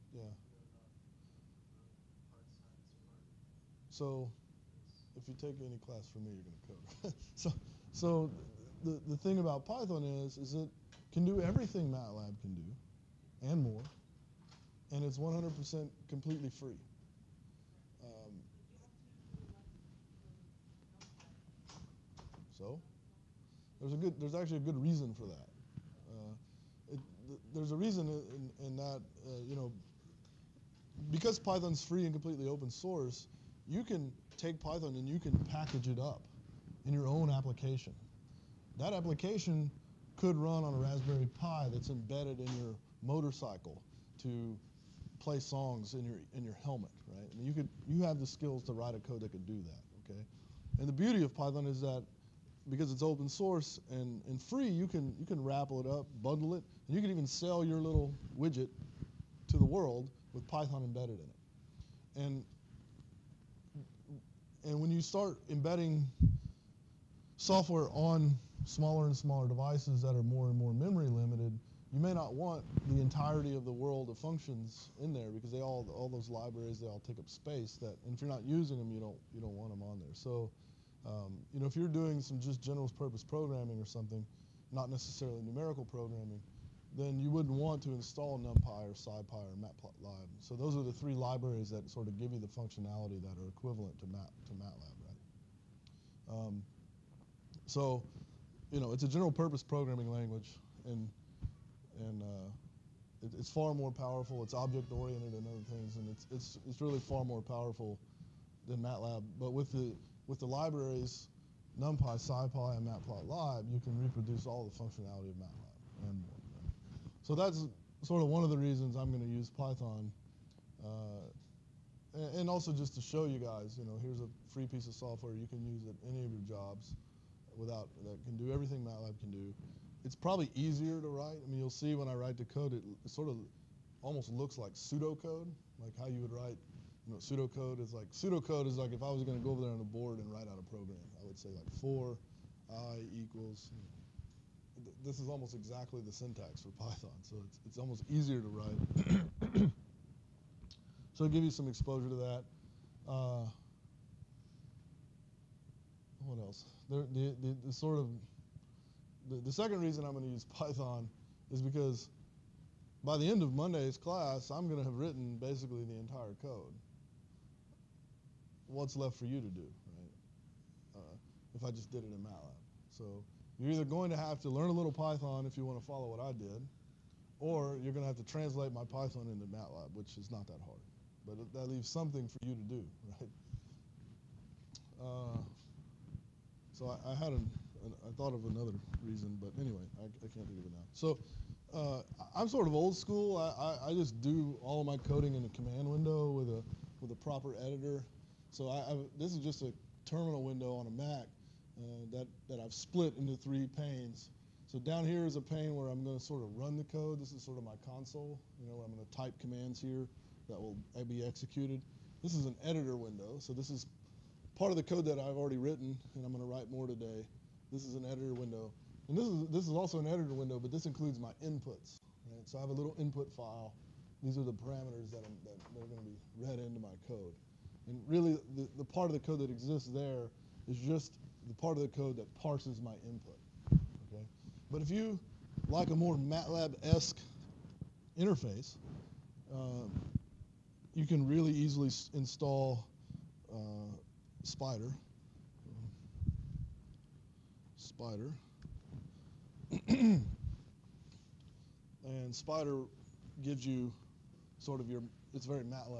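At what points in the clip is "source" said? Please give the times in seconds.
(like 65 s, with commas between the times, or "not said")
32 s, 53 s.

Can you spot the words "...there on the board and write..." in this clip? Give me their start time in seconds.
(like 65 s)
139 s.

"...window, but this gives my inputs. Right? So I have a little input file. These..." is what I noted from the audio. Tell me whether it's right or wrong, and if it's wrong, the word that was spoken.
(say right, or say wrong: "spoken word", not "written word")
wrong: "includes", not "gives".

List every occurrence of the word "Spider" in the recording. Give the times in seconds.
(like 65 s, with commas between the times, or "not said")
247 s, 252 s.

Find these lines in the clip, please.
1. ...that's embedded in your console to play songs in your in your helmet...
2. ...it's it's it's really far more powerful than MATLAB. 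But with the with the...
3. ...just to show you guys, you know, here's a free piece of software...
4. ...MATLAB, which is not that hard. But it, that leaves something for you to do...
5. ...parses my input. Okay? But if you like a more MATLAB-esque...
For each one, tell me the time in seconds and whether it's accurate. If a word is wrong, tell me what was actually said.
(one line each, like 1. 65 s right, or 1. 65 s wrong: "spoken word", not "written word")
1. 41 s wrong: "motorcycle", not "console"
2. 106 s right
3. 122 s right
4. 179 s right
5. 232 s right.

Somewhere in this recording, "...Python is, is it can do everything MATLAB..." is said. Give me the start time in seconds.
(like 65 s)
9 s.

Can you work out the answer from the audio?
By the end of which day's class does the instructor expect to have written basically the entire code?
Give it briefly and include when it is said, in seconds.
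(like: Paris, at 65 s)
Monday, at 163 s.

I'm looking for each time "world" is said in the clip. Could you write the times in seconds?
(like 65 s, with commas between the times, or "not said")
59 s, 73 s.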